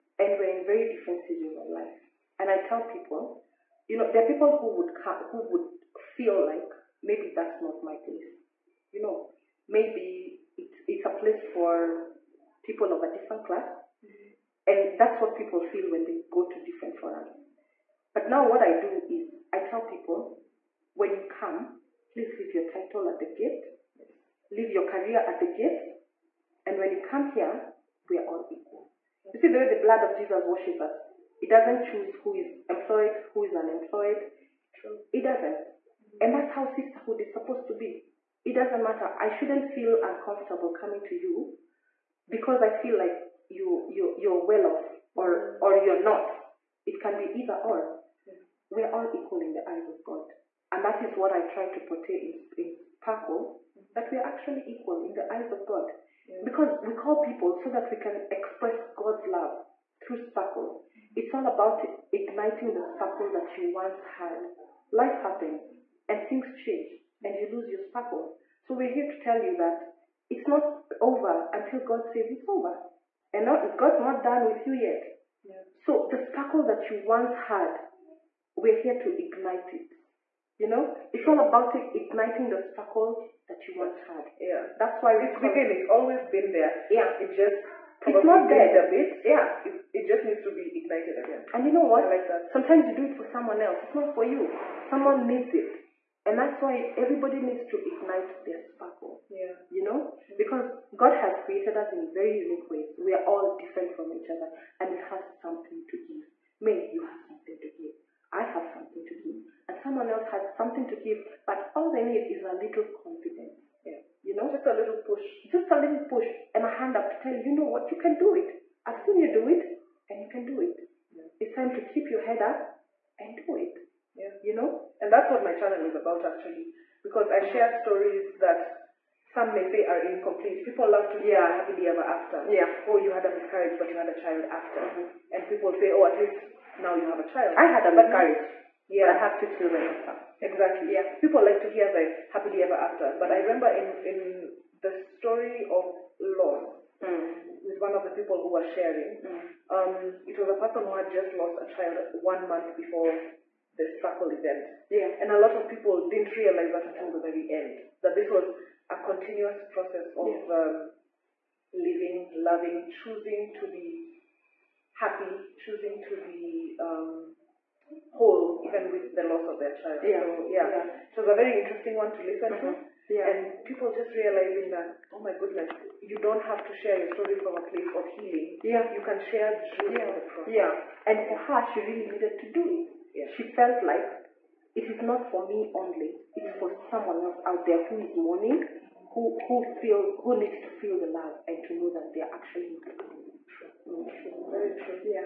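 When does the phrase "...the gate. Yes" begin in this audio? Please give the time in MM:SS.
00:23.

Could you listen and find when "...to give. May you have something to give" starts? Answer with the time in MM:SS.
01:45.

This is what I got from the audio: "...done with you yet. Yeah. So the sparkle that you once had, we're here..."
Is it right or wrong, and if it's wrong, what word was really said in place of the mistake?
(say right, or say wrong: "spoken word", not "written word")
right.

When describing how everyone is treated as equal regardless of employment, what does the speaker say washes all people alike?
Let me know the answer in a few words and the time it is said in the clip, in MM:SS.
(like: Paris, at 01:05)
the blood of Jesus, at 00:29.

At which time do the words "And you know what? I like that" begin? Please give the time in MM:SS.
01:31.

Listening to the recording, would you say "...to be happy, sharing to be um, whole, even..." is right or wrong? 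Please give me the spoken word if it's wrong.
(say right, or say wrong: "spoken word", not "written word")
wrong: "choosing", not "sharing".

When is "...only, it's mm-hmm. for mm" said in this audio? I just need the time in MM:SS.
03:05.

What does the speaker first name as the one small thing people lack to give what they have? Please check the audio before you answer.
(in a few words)
a little confidence.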